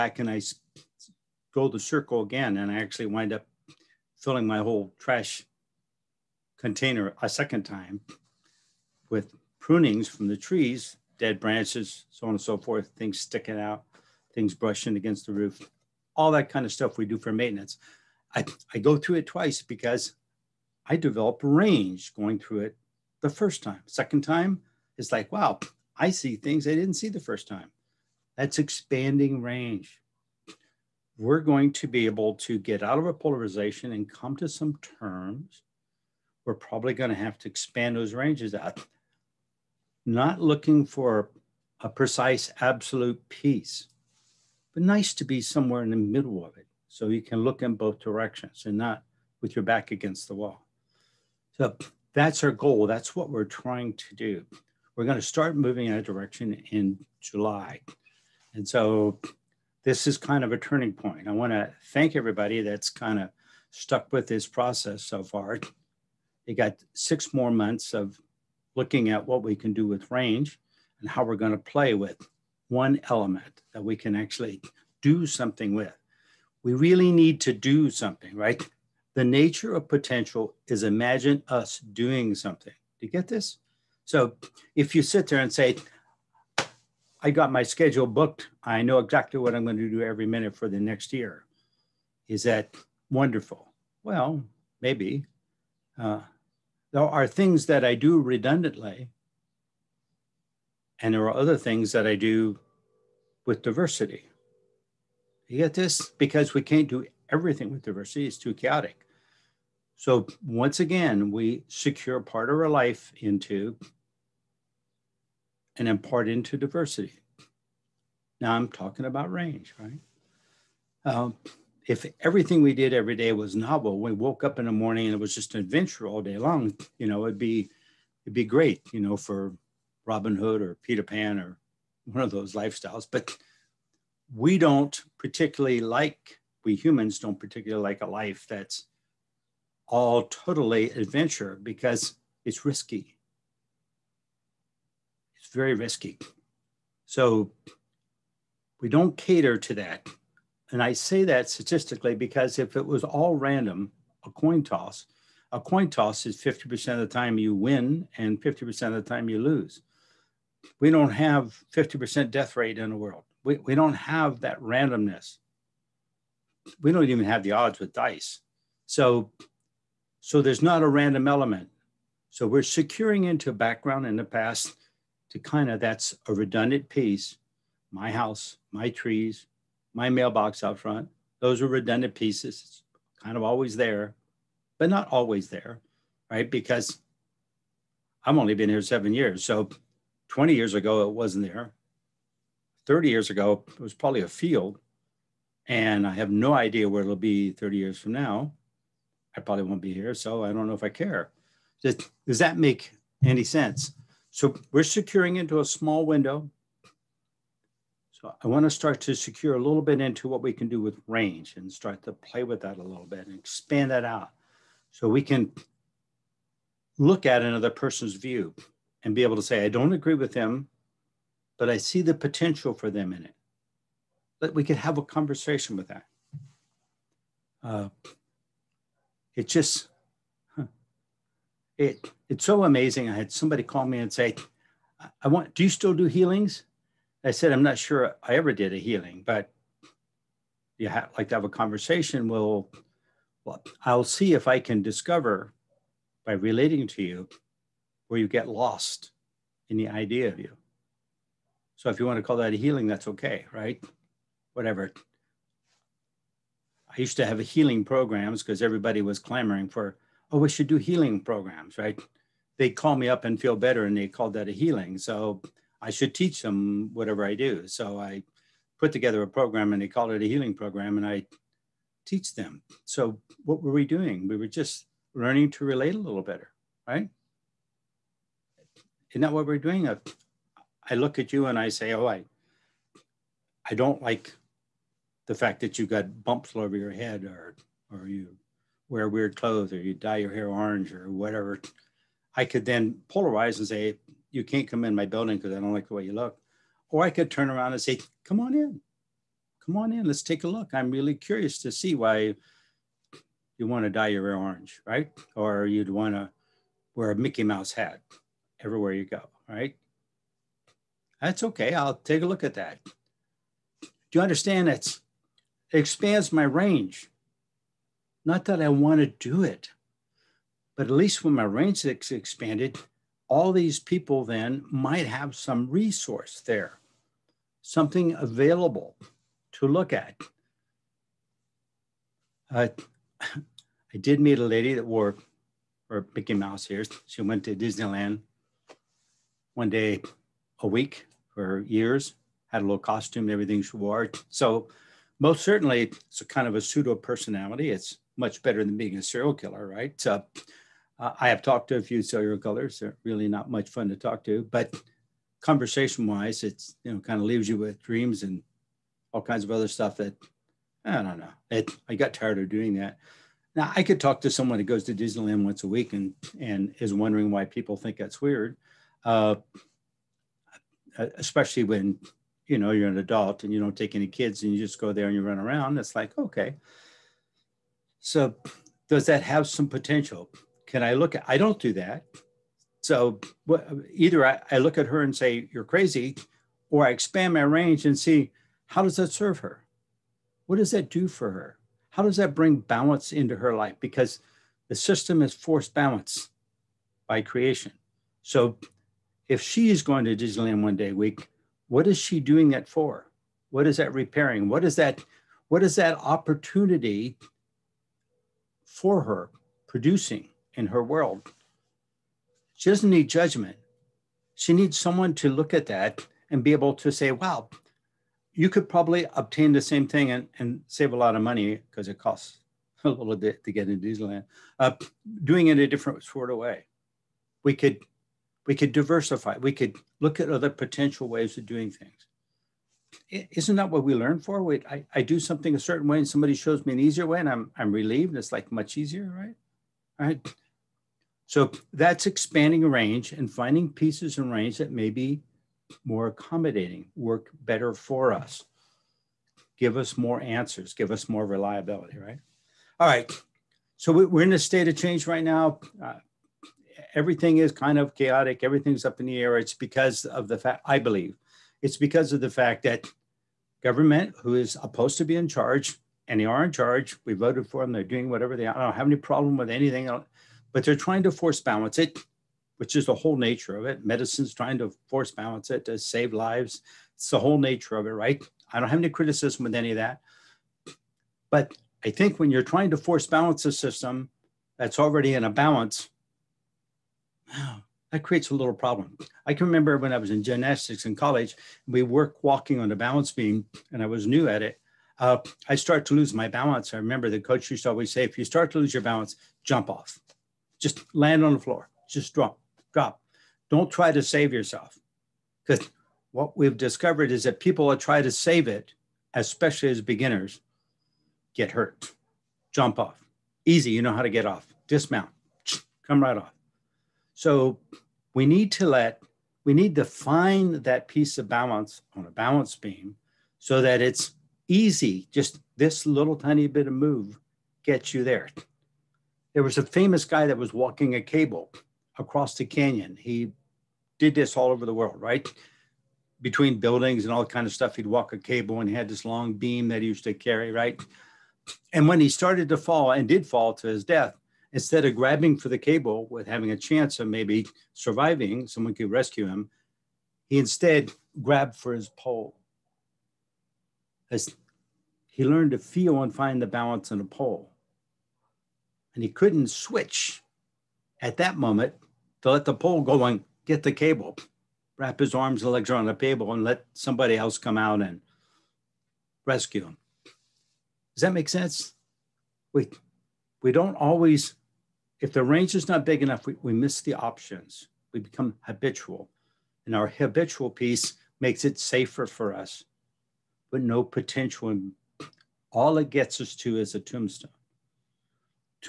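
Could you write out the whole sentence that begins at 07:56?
It's the whole nature of it, right?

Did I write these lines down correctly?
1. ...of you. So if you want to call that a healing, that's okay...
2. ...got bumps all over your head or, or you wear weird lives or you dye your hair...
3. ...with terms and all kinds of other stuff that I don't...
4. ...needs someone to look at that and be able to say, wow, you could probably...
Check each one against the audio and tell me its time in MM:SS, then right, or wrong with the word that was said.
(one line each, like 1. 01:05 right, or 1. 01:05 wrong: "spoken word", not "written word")
1. 04:10 right
2. 04:45 wrong: "clothes", not "lives"
3. 05:57 wrong: "dreams", not "terms"
4. 06:54 right.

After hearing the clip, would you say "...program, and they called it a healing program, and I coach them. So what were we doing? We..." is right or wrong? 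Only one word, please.
wrong.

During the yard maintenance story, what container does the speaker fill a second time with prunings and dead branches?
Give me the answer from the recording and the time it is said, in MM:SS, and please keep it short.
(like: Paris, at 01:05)
trash container, at 00:04.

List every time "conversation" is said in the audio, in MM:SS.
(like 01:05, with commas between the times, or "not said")
03:45, 04:01, 05:55.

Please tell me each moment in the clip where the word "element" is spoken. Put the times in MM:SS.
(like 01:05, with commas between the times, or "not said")
01:13, 02:51.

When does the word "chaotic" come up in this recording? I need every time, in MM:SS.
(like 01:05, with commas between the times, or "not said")
01:48, 07:37.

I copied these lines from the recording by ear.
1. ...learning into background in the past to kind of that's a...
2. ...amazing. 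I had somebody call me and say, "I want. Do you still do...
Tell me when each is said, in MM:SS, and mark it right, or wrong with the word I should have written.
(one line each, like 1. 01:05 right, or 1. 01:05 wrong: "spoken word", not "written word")
1. 02:52 wrong: "securing", not "learning"
2. 03:52 right.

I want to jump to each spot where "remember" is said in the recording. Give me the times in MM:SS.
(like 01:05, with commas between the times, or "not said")
08:09, 08:16.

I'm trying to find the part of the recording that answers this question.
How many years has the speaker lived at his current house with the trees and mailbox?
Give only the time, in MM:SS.
03:08.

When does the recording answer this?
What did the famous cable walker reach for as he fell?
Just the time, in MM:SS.
09:11.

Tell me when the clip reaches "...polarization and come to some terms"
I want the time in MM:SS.
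00:33.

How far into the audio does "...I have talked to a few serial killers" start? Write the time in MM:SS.
05:50.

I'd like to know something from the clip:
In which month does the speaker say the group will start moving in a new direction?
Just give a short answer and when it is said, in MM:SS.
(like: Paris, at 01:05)
July, at 00:57.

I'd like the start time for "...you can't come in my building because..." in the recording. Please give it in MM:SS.
04:54.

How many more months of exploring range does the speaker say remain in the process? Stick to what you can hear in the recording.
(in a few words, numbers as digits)
6.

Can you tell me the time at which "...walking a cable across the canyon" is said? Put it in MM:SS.
08:50.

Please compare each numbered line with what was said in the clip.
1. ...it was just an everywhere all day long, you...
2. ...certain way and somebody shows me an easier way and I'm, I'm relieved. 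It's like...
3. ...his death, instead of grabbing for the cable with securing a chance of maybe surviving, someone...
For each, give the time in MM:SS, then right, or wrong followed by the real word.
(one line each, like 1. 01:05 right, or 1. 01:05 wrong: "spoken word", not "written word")
1. 02:05 wrong: "adventure", not "everywhere"
2. 07:15 right
3. 09:03 wrong: "having", not "securing".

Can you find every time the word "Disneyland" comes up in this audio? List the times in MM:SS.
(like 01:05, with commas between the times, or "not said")
05:37, 06:04, 06:40, 07:03.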